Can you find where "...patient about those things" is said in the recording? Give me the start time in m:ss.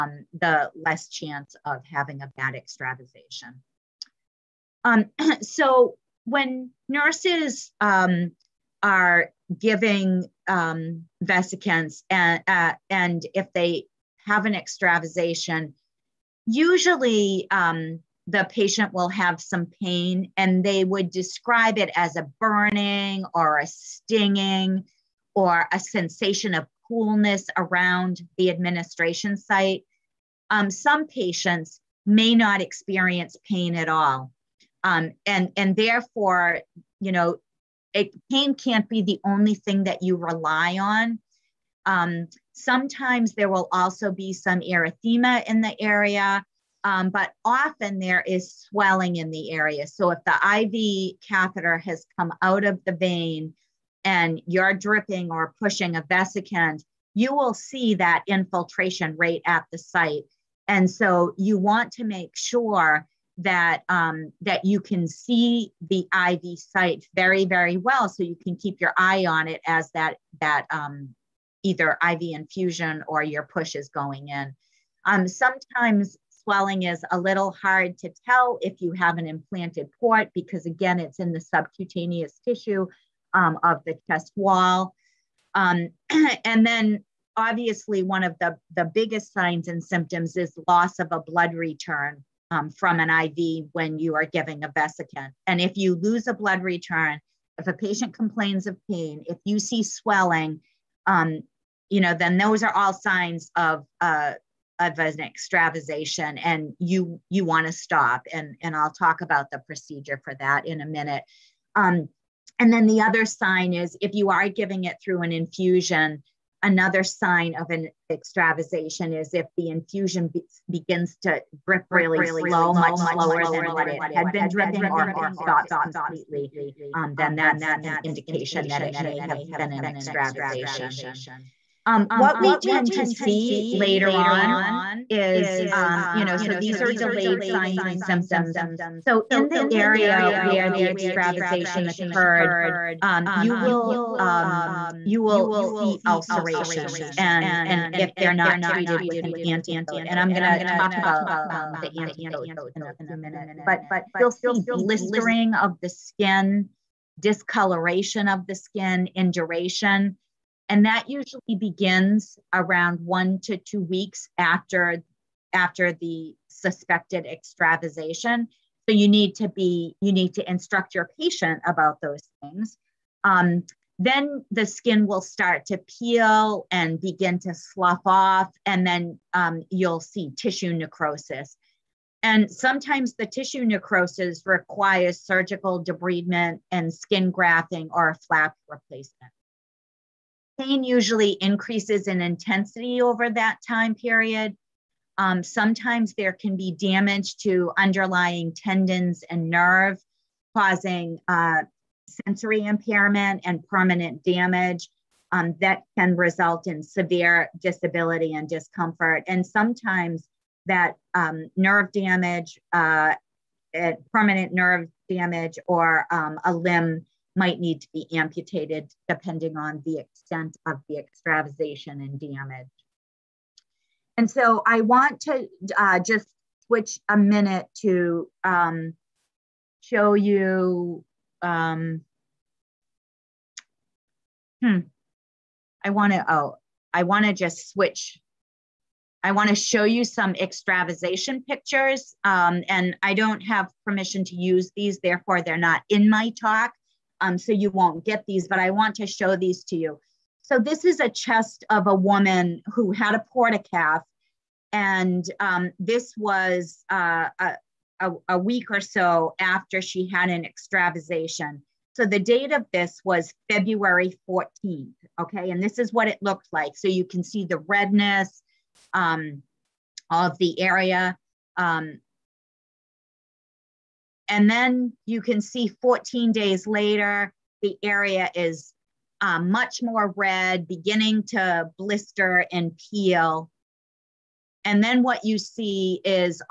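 2:51.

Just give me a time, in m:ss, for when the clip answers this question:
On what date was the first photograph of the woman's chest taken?
4:23.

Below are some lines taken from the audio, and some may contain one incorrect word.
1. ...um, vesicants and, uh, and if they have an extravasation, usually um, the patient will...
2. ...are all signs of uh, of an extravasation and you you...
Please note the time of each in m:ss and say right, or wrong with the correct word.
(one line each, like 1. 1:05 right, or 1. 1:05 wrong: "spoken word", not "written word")
1. 0:10 right
2. 1:42 right.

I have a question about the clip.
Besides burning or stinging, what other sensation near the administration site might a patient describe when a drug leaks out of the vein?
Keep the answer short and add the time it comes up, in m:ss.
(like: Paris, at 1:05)
coolness, at 0:26.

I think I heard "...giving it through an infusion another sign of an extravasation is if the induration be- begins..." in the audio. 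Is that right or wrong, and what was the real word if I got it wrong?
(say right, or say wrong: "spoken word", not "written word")
wrong: "infusion", not "induration".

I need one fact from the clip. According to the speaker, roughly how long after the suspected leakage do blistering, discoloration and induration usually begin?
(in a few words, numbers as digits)
1 to 2 weeks.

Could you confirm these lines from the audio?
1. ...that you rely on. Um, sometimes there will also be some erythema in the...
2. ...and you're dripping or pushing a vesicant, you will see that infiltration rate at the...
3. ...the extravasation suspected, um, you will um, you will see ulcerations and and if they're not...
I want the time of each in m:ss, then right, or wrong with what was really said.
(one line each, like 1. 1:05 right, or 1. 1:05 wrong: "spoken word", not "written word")
1. 0:39 right
2. 0:54 right
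3. 2:20 wrong: "occurred", not "suspected".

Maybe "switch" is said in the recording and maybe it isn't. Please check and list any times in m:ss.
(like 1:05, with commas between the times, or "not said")
3:46, 3:57.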